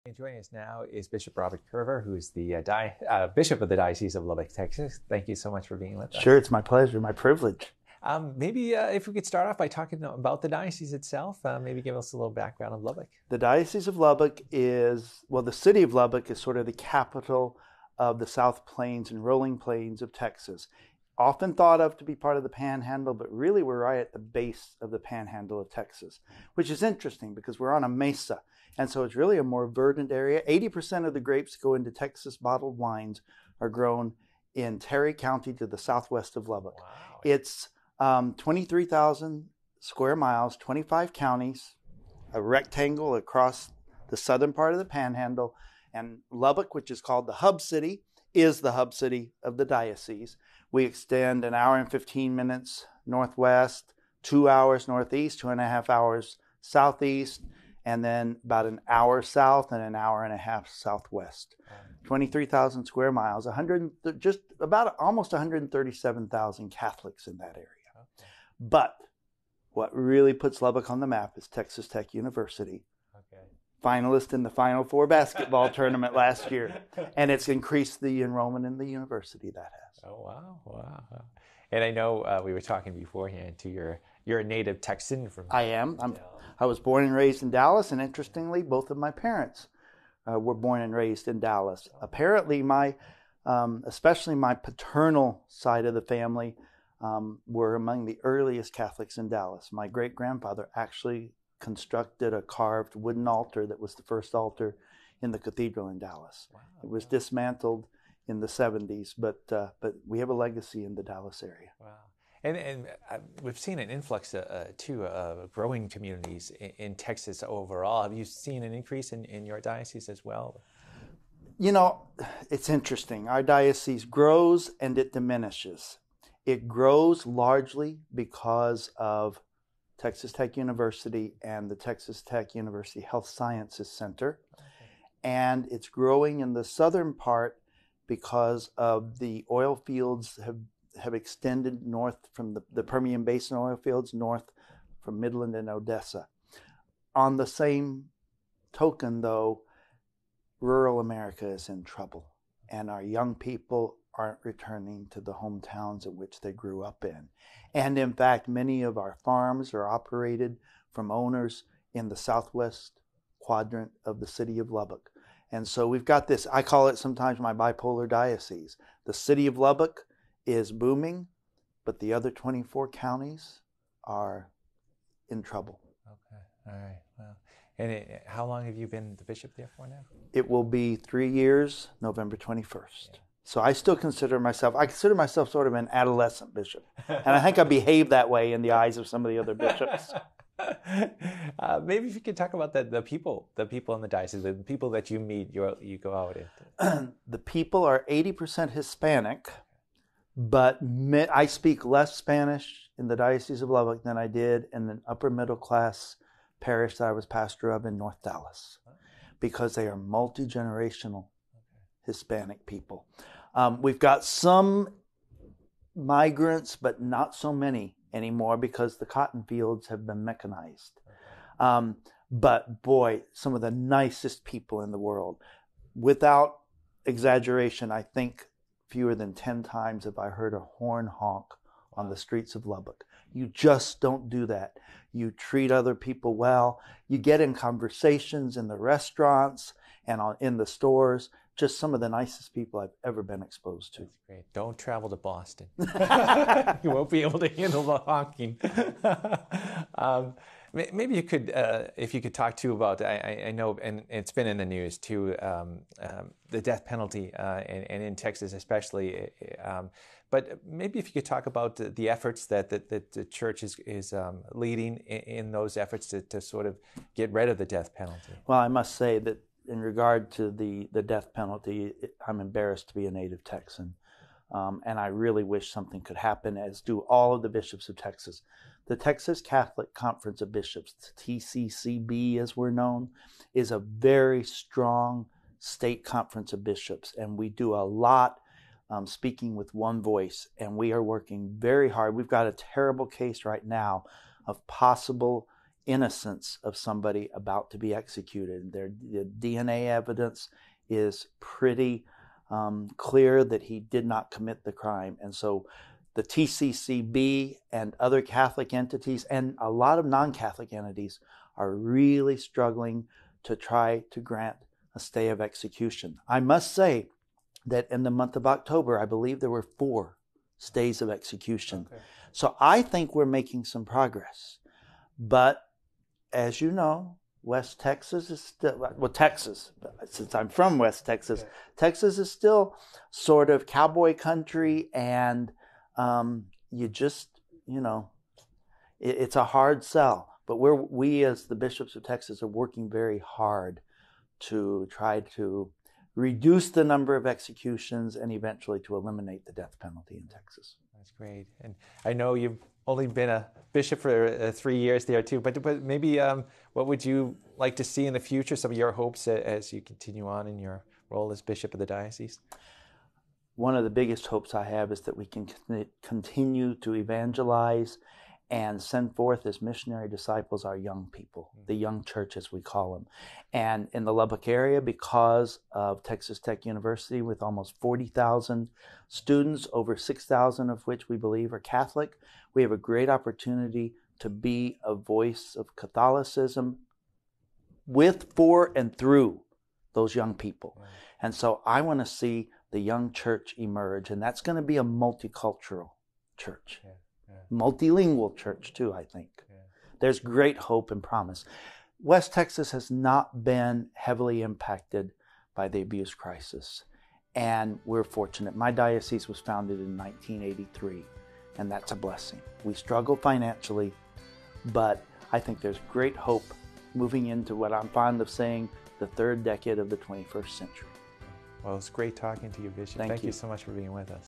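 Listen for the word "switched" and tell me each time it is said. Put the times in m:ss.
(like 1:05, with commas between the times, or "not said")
not said.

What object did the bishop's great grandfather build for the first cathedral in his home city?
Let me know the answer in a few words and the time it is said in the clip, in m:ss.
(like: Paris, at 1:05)
carved wooden altar, at 1:42.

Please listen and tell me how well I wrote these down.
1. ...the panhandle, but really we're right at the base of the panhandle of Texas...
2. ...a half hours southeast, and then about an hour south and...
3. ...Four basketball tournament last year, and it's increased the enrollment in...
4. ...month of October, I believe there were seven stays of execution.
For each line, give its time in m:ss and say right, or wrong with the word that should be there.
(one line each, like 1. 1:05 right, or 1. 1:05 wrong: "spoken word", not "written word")
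1. 0:22 right
2. 0:55 right
3. 1:14 right
4. 5:18 wrong: "four", not "seven".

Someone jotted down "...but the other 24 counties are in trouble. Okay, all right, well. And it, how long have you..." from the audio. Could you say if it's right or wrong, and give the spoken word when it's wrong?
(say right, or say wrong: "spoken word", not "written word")
right.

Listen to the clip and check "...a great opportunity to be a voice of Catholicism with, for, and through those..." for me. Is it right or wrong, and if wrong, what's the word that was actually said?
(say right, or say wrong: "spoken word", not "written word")
right.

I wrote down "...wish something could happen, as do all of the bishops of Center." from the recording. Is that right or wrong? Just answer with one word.
wrong.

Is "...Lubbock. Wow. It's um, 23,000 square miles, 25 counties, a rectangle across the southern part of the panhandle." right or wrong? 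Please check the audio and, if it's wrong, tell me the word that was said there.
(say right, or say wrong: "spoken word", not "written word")
right.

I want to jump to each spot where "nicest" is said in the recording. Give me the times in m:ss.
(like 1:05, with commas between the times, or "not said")
3:43, 4:02.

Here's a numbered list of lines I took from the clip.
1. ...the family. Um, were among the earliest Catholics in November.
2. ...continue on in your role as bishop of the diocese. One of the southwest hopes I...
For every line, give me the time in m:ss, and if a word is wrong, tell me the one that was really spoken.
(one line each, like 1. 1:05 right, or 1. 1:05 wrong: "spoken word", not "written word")
1. 1:35 wrong: "Dallas", not "November"
2. 5:59 wrong: "biggest", not "southwest".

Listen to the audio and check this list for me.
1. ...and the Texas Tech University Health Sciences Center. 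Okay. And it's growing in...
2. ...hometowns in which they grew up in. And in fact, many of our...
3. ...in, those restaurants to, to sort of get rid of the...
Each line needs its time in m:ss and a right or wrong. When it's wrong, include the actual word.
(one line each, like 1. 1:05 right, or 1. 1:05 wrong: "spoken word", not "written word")
1. 2:11 right
2. 2:35 right
3. 4:25 wrong: "efforts", not "restaurants".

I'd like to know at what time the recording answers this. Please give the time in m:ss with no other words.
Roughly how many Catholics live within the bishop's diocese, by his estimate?
1:05.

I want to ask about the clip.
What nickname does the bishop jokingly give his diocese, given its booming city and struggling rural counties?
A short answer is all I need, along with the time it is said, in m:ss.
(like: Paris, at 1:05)
bipolar diocese, at 2:47.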